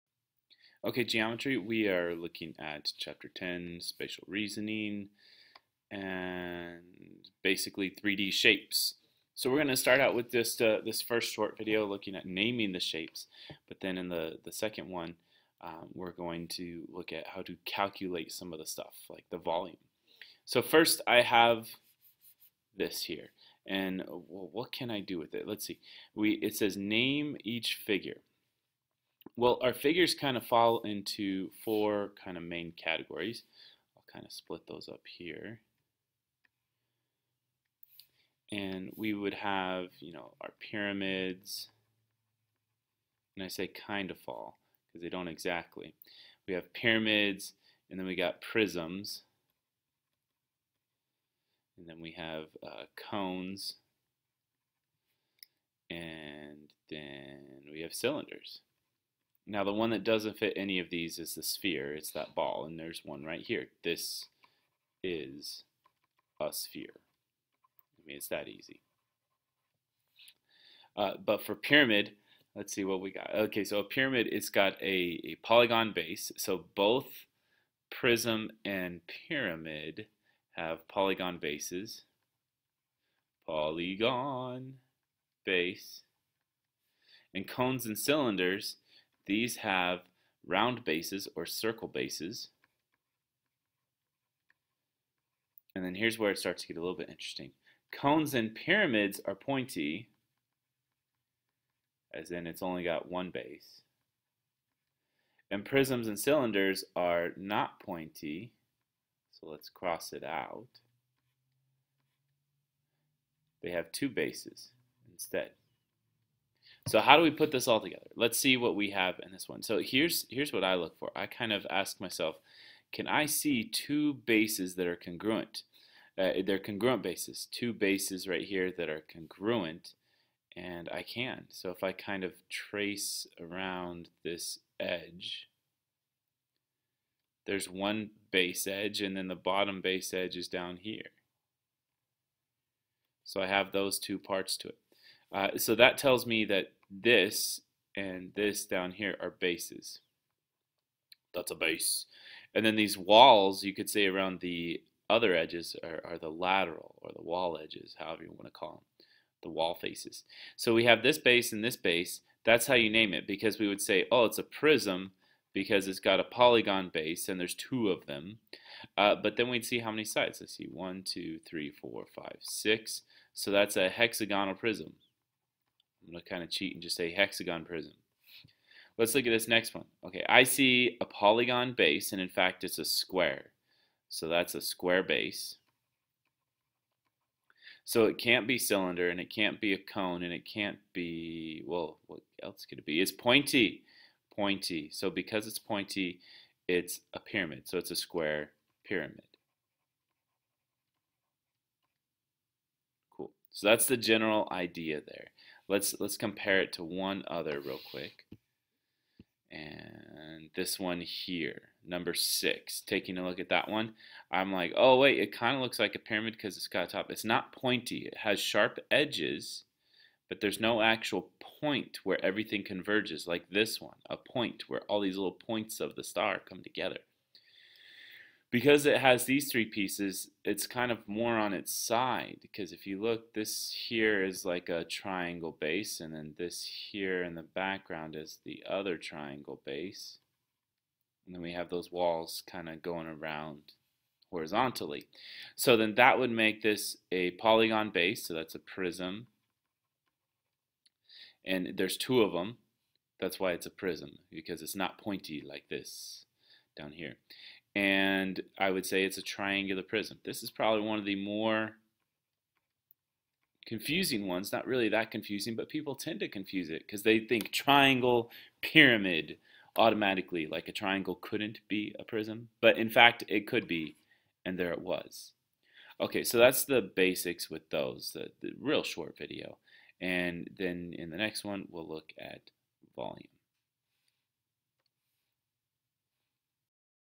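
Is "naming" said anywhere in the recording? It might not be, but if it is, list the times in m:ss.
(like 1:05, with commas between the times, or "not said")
0:12.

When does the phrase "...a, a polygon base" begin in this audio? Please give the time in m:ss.
1:14.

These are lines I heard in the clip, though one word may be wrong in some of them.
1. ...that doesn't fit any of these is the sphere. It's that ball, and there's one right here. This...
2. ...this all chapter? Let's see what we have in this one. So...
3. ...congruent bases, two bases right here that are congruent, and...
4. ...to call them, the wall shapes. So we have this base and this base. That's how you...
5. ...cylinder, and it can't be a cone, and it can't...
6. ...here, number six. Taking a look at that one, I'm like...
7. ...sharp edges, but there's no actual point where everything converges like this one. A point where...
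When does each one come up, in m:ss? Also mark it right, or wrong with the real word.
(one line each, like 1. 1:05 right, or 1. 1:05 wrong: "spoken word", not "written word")
1. 0:59 right
2. 1:57 wrong: "together", not "chapter"
3. 2:06 right
4. 2:38 wrong: "faces", not "shapes"
5. 3:08 right
6. 3:30 right
7. 3:38 right.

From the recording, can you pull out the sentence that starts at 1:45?
And prisms and cylinders are not pointy, so let's cross it out.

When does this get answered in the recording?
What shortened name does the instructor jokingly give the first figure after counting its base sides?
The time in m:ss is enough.
2:57.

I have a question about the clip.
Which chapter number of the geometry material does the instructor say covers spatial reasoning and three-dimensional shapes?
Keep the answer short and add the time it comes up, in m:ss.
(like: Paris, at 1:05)
10, at 0:02.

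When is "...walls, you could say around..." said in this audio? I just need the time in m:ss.
2:32.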